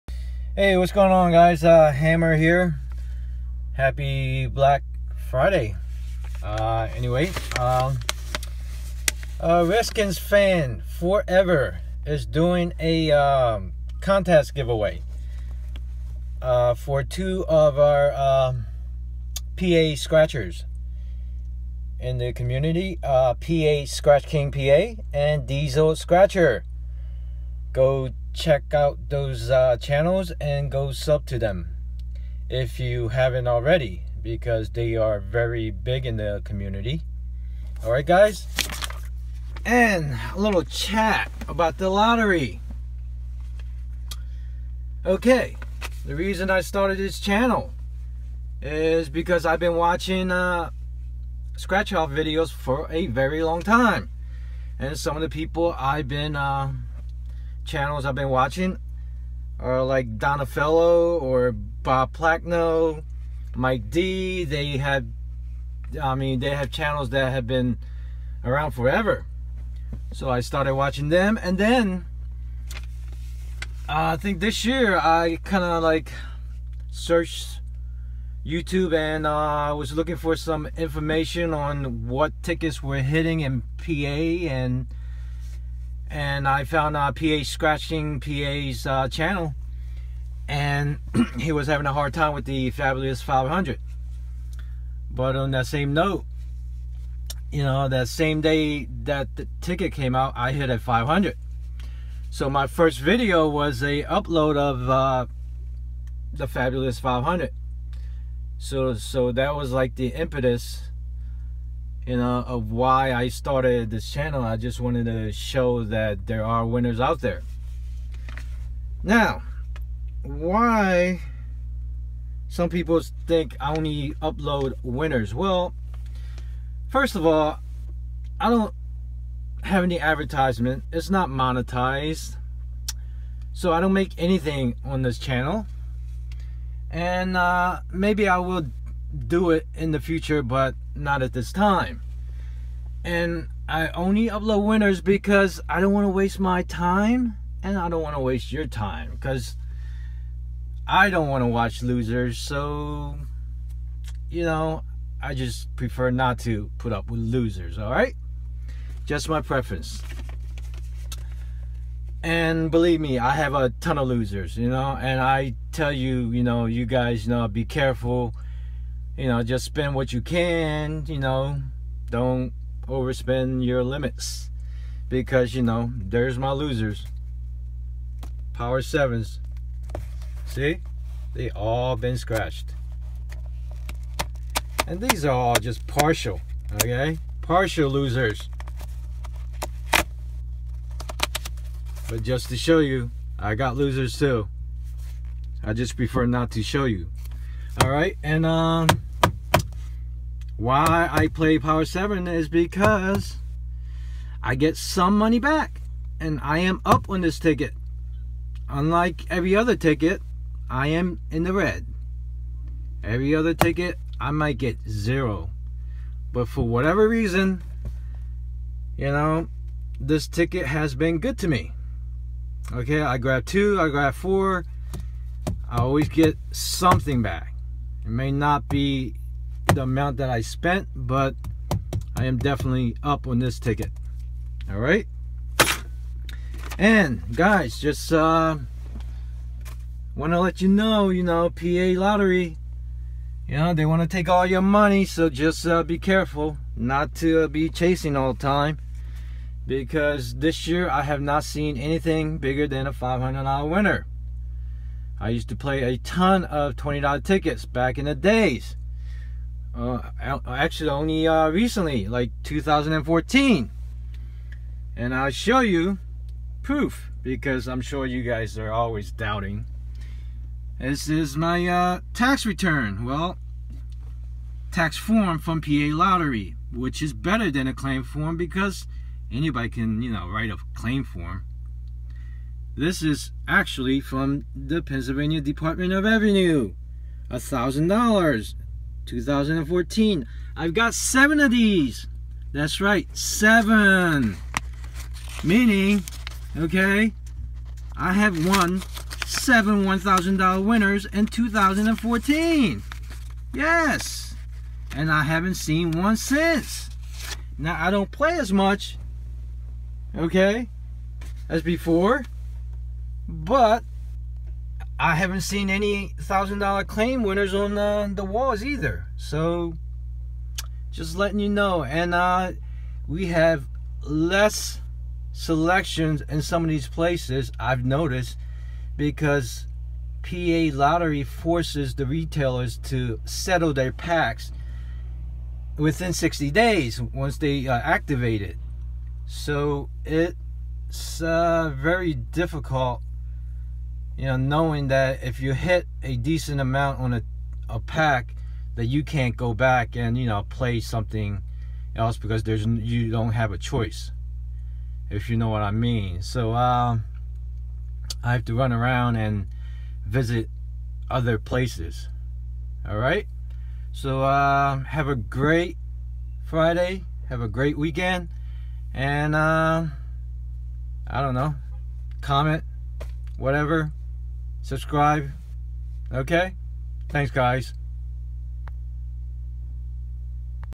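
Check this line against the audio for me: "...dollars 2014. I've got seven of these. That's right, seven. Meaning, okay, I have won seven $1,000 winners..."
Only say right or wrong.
right.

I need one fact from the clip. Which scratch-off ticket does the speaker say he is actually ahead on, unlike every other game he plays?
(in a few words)
Power 7.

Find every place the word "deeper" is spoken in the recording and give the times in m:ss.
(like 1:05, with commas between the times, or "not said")
not said.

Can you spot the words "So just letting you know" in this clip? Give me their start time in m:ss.
5:19.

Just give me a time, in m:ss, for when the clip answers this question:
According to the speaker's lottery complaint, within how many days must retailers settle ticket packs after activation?
5:36.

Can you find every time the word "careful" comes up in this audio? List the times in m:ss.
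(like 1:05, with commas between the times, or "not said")
2:47, 4:05.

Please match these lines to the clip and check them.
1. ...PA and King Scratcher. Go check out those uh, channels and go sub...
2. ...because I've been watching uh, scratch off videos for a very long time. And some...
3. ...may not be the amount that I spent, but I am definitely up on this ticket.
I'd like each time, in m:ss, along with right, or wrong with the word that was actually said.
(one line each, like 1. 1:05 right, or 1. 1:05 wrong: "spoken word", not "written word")
1. 0:24 wrong: "Diesel", not "King"
2. 0:49 right
3. 3:48 right.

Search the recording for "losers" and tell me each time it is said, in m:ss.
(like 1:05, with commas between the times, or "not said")
2:31, 2:37, 2:44, 2:56, 3:07, 3:13.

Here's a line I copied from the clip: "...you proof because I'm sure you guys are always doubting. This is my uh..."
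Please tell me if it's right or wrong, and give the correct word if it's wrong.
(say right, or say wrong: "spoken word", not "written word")
right.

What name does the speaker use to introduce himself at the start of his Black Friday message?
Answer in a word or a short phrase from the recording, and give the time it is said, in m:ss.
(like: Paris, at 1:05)
Hammer, at 0:01.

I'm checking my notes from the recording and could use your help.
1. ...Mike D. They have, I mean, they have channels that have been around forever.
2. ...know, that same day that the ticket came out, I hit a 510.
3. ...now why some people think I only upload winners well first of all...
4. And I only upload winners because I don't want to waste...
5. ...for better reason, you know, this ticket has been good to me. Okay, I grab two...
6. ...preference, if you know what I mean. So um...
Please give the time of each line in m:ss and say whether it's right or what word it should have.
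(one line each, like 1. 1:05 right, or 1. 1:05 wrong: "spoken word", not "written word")
1. 1:03 right
2. 1:37 wrong: "500", not "510"
3. 1:59 right
4. 2:23 right
5. 3:36 wrong: "whatever", not "better"
6. 5:53 wrong: "choice", not "preference".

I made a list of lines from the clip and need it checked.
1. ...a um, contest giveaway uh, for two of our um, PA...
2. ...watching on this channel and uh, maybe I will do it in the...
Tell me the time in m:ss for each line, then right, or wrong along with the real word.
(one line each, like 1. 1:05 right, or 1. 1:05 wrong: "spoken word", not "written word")
1. 0:12 right
2. 2:14 wrong: "anything", not "watching".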